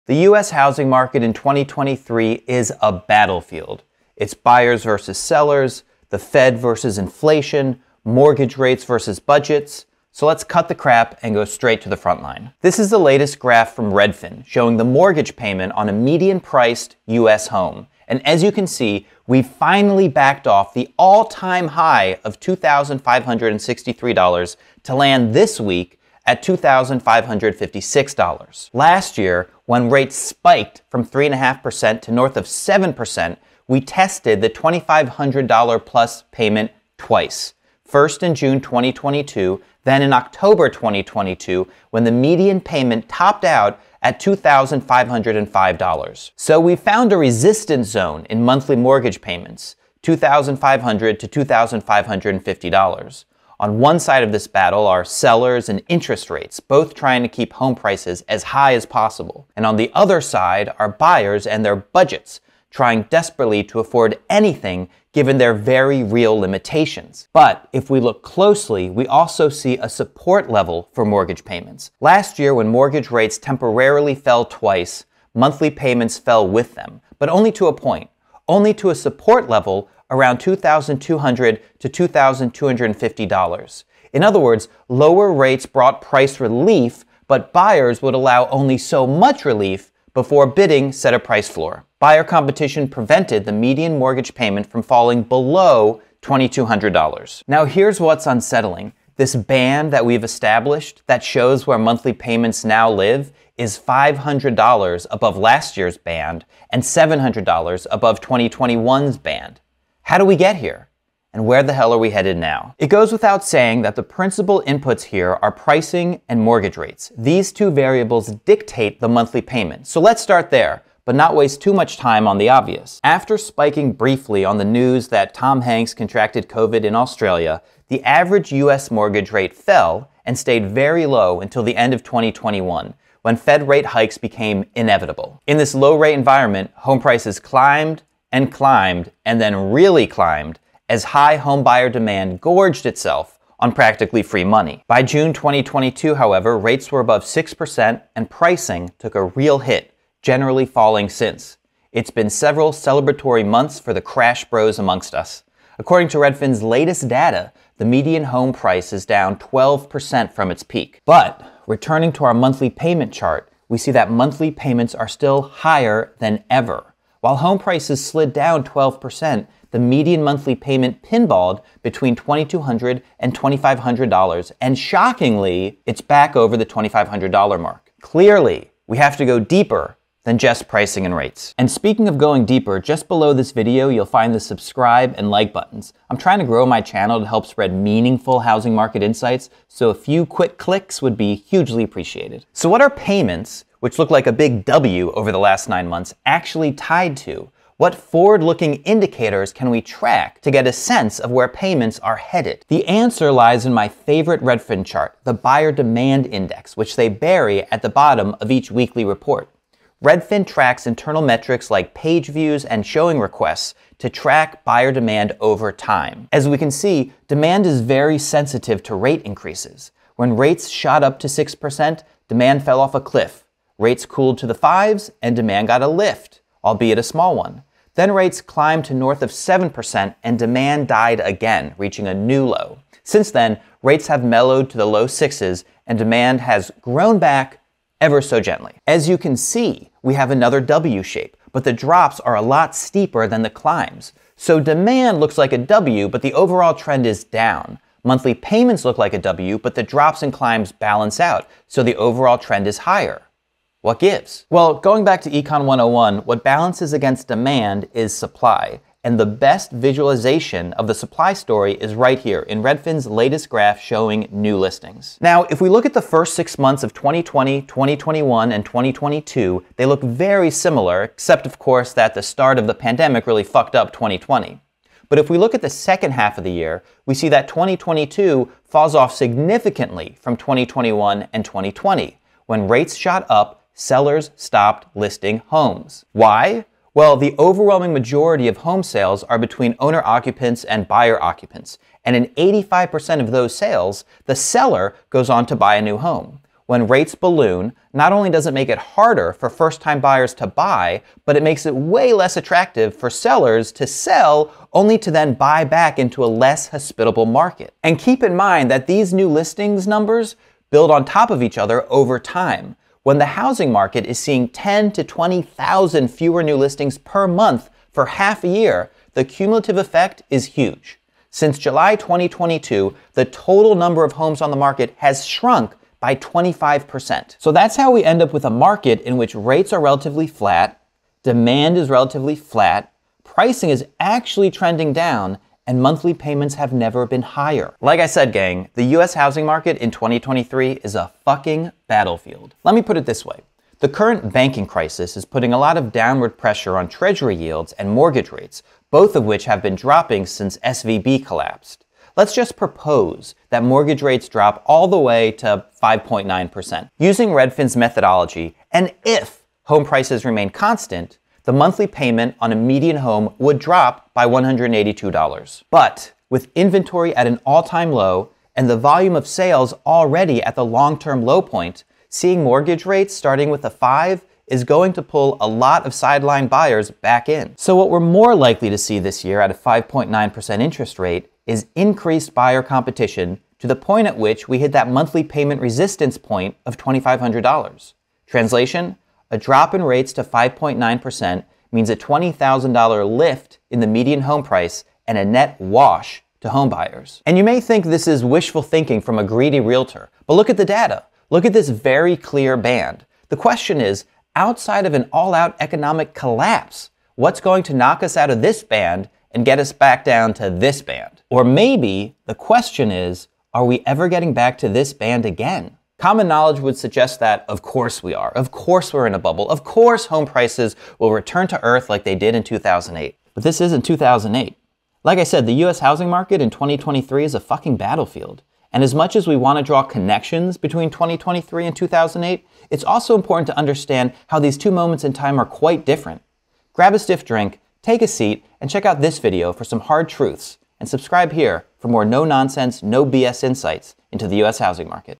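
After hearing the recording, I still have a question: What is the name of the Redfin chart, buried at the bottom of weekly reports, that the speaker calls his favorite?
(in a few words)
Buyer Demand Index.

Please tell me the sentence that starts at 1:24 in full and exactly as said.
In other words, lower rates brought price relief, but buyers would allow only so much relief before bidding set a price floor.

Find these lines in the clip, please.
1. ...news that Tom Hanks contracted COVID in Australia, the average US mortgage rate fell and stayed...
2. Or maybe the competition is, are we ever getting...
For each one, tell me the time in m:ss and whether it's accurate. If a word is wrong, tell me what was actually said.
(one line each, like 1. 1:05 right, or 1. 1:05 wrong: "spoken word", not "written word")
1. 2:04 right
2. 6:51 wrong: "question", not "competition".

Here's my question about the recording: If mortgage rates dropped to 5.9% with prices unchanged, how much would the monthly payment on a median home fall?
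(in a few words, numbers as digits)
$182.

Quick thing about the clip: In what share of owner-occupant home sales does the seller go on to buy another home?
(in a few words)
85%.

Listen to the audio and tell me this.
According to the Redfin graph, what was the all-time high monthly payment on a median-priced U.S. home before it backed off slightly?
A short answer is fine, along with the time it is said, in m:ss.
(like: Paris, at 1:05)
$2,563, at 0:22.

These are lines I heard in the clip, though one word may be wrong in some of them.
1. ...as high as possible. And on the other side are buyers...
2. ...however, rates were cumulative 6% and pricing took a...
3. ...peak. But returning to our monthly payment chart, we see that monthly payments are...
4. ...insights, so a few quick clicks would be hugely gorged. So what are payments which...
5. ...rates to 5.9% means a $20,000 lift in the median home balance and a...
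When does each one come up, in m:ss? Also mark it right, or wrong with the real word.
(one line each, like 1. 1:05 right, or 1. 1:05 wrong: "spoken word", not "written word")
1. 0:58 right
2. 2:26 wrong: "above", not "cumulative"
3. 2:40 right
4. 3:09 wrong: "appreciated", not "gorged"
5. 6:29 wrong: "price", not "balance".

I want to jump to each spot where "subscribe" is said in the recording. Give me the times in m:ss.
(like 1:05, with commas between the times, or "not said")
3:04, 7:20.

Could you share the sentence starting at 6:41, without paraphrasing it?
Look at this very clear band.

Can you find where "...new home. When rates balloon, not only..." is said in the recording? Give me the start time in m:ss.
4:55.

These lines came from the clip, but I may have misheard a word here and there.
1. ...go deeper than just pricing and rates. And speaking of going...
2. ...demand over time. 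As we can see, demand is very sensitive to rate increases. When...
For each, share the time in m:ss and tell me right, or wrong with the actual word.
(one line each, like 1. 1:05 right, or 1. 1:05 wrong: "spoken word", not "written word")
1. 2:59 right
2. 3:34 right.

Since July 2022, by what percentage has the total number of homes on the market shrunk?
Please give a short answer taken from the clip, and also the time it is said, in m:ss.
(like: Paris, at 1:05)
25%, at 5:26.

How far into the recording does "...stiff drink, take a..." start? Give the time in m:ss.
7:16.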